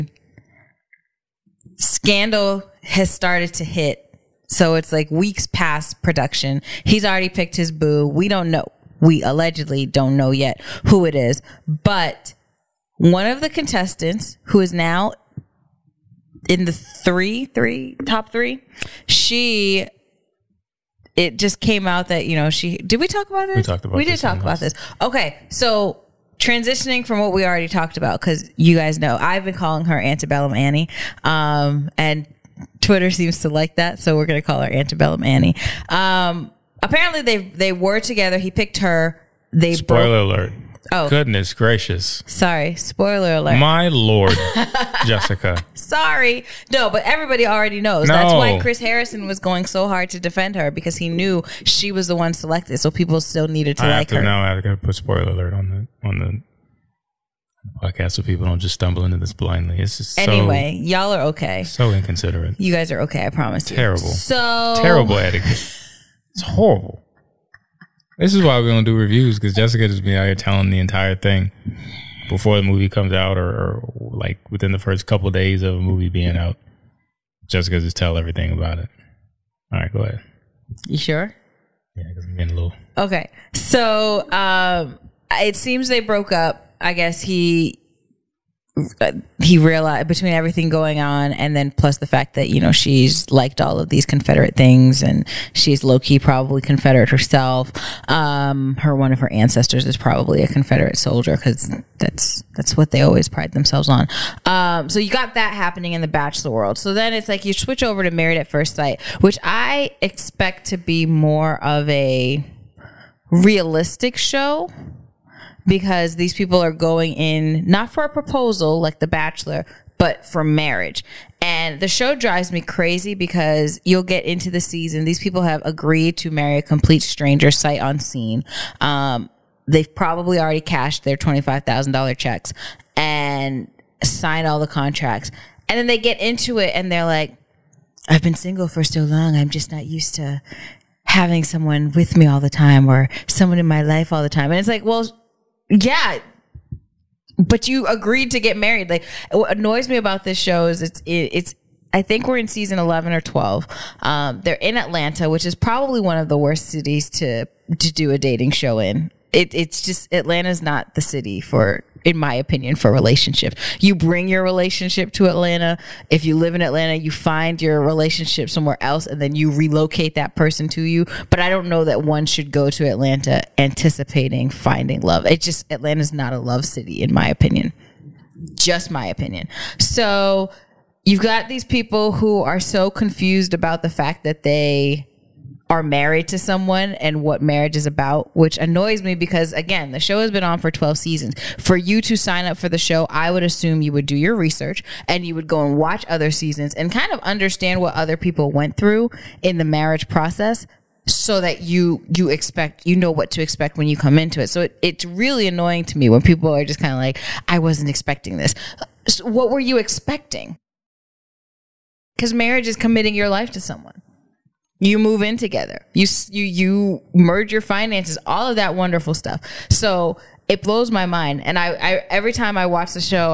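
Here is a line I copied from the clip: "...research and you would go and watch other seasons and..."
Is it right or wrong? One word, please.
right.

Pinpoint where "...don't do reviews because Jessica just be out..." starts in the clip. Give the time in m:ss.
1:08.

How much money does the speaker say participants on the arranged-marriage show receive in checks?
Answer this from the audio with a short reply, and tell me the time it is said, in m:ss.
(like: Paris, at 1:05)
$25,000, at 2:11.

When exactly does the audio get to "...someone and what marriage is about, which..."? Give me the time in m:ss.
3:06.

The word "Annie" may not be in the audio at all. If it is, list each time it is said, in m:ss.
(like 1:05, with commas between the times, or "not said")
0:30, 0:35.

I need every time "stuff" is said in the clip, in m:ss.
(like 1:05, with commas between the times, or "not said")
3:39.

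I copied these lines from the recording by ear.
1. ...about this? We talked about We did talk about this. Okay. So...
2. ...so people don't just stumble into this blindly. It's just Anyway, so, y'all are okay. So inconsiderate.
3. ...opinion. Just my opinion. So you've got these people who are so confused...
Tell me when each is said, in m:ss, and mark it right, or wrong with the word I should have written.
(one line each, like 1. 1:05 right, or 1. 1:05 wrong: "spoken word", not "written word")
1. 0:23 right
2. 0:58 right
3. 2:57 right.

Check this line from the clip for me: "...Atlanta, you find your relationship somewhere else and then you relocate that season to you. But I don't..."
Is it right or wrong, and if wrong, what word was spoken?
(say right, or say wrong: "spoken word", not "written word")
wrong: "person", not "season".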